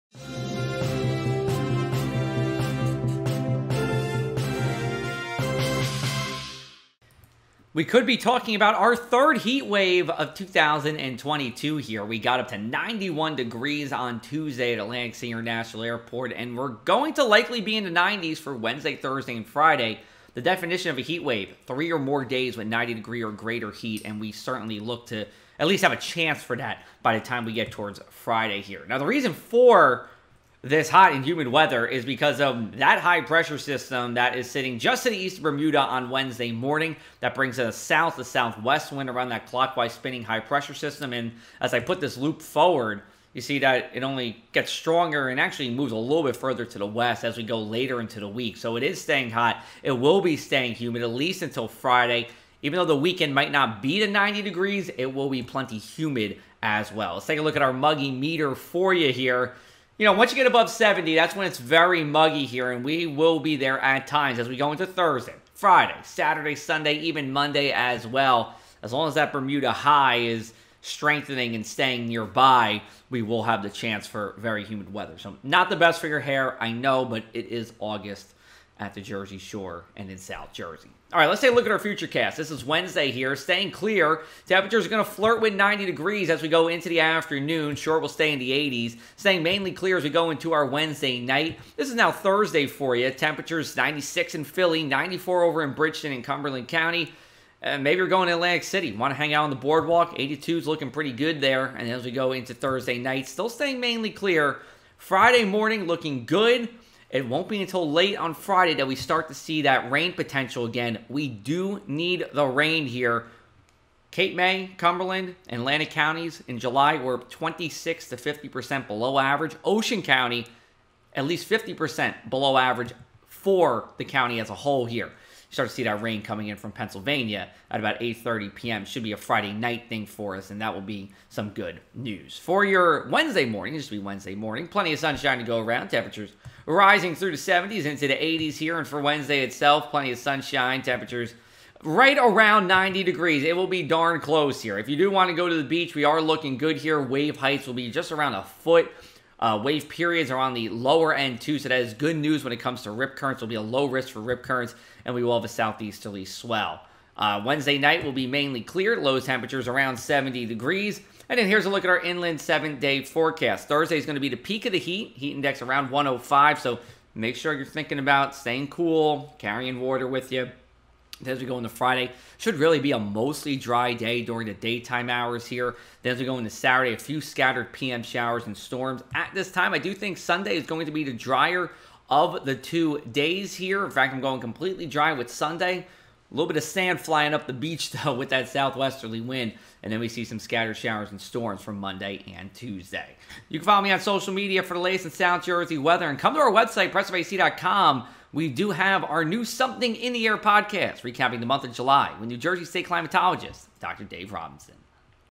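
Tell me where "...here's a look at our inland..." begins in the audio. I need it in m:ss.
2:41.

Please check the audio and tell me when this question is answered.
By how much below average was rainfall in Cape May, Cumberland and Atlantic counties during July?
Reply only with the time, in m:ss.
1:57.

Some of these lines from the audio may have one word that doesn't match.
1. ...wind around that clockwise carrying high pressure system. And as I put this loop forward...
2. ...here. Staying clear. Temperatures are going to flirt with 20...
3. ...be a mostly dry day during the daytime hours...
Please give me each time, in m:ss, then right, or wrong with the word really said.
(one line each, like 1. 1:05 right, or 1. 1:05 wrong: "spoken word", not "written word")
1. 0:38 wrong: "spinning", not "carrying"
2. 1:23 wrong: "90", not "20"
3. 2:52 right.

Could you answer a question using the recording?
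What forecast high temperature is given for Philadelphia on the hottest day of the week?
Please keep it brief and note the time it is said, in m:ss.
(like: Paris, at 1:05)
96, at 1:33.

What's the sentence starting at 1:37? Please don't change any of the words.
Uh, maybe you're going to Atlantic City.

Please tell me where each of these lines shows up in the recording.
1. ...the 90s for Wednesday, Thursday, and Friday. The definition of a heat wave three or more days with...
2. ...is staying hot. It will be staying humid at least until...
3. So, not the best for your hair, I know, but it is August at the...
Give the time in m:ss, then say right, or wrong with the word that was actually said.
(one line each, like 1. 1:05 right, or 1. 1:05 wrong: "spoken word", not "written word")
1. 0:17 right
2. 0:48 right
3. 1:15 right.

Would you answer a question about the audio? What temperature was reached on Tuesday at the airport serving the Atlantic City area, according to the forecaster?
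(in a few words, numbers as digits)
91 degrees.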